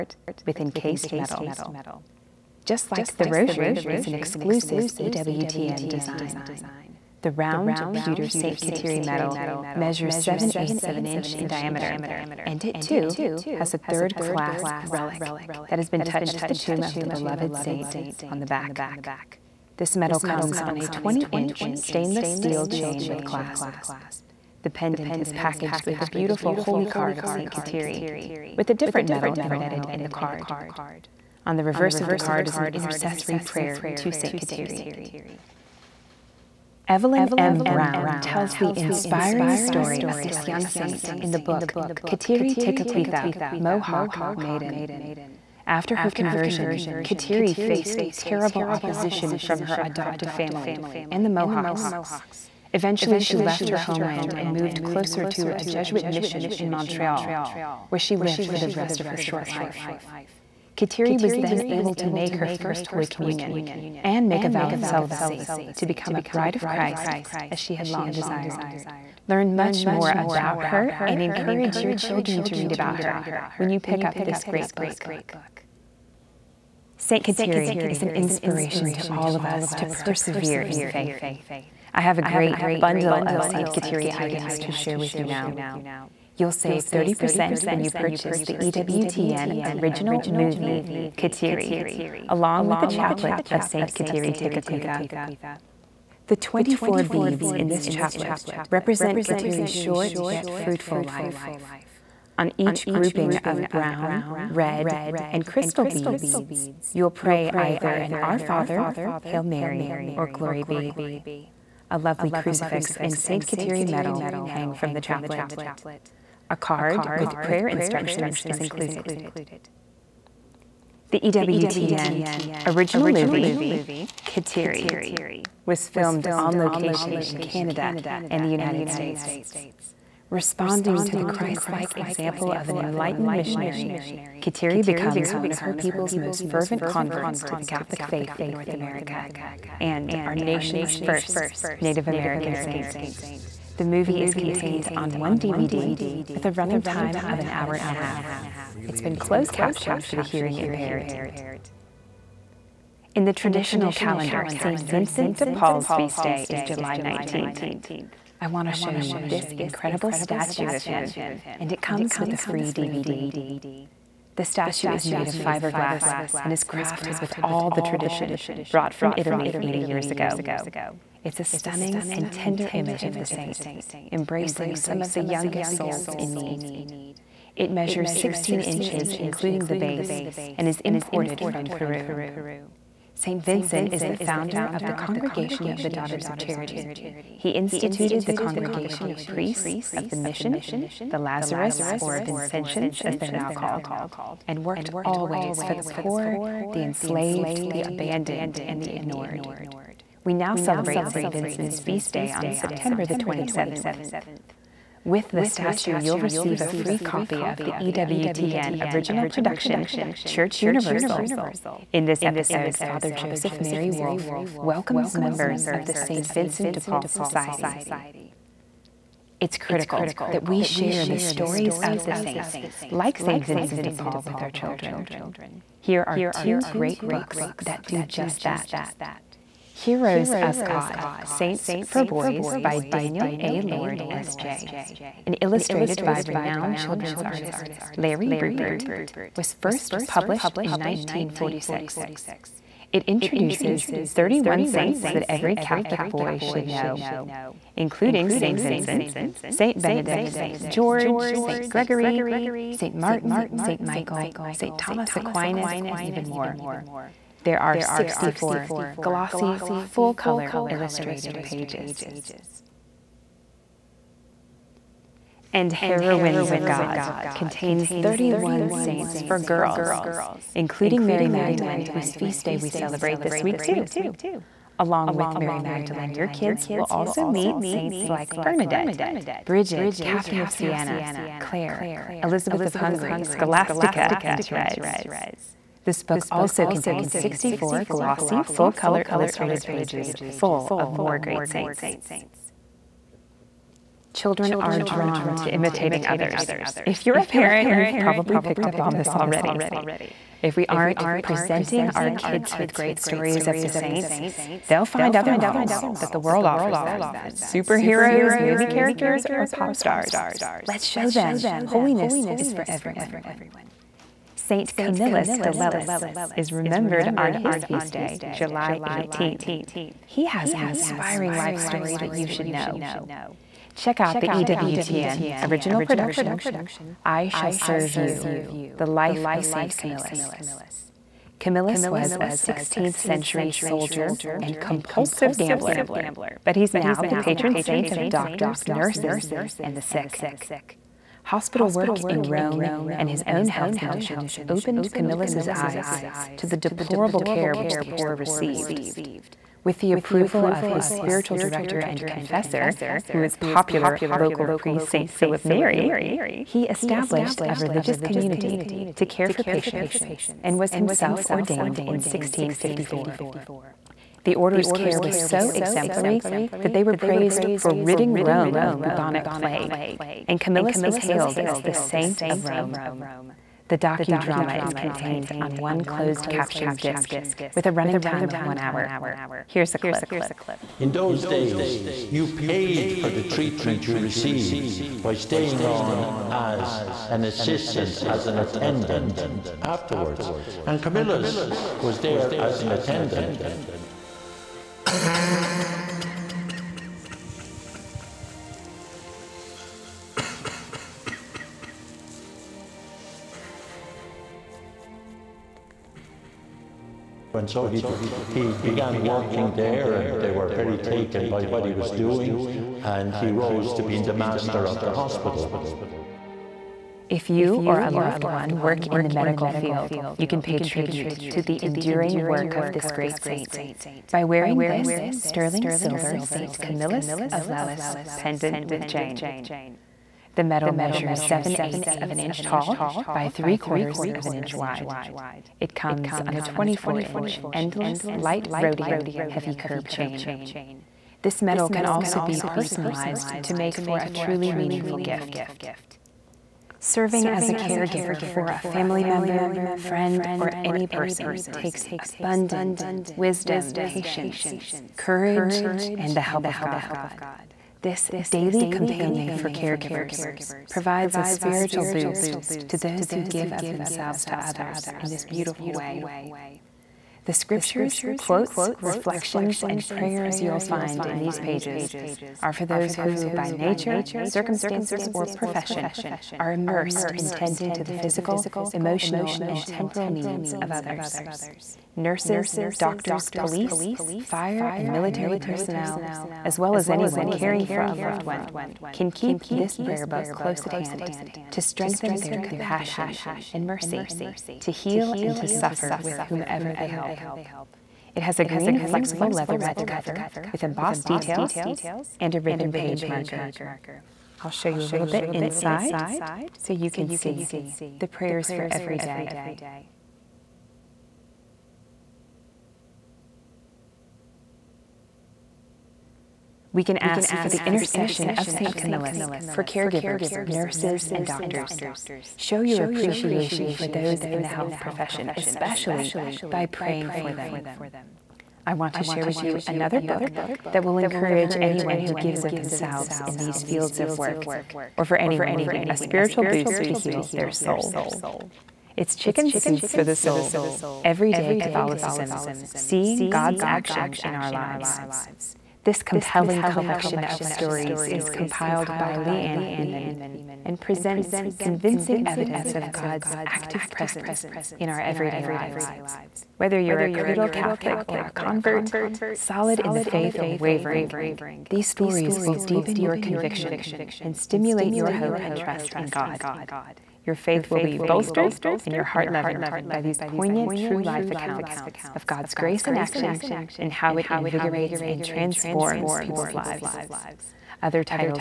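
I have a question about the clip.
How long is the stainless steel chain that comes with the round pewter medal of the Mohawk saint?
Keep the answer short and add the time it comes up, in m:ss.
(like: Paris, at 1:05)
20 inch, at 0:20.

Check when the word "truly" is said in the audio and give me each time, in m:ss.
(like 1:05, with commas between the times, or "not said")
7:24.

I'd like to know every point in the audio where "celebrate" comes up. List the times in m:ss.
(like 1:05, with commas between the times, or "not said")
3:20, 4:32.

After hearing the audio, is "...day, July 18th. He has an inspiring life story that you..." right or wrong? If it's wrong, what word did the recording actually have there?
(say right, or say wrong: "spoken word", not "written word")
right.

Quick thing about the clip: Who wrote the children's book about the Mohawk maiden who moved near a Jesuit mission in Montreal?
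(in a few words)
Evelyn M. Brown.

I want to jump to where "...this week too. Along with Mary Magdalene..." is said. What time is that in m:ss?
4:33.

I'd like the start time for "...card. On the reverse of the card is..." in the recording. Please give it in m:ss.
0:30.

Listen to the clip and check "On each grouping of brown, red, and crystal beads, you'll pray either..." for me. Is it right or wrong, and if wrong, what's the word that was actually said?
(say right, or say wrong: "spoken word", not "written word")
right.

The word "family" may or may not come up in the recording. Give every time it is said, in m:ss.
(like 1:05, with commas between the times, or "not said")
0:50, 7:28.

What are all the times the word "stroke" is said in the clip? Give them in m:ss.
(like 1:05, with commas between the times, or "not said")
not said.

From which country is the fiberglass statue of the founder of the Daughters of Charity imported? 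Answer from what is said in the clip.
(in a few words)
Peru.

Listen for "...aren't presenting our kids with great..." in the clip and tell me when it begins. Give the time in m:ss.
5:00.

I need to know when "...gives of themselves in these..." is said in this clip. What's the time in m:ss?
8:52.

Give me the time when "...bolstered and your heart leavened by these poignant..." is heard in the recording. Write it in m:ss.
9:27.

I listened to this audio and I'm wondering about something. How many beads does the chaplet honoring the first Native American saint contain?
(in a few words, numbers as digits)
24.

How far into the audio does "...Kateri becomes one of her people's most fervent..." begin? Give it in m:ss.
2:14.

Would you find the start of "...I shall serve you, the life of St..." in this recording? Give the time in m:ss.
5:27.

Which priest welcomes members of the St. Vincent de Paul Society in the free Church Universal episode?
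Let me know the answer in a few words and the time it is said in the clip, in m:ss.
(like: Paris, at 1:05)
Father Joseph Mary Wolfe, at 3:32.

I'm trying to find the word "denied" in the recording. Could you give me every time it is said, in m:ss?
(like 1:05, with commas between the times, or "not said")
not said.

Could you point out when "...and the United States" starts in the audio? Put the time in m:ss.
2:08.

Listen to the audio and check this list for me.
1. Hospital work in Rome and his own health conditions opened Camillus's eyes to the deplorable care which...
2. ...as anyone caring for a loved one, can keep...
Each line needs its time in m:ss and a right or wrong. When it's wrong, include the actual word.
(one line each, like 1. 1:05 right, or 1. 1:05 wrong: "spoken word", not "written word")
1. 5:41 right
2. 8:06 right.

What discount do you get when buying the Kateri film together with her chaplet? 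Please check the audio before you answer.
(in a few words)
30%.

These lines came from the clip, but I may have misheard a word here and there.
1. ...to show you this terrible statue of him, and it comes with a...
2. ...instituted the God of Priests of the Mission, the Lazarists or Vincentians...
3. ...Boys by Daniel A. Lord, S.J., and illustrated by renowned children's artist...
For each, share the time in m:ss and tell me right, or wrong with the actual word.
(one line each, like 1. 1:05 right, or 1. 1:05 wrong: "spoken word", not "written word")
1. 2:38 wrong: "incredible", not "terrible"
2. 3:07 wrong: "Congregation", not "God"
3. 3:52 right.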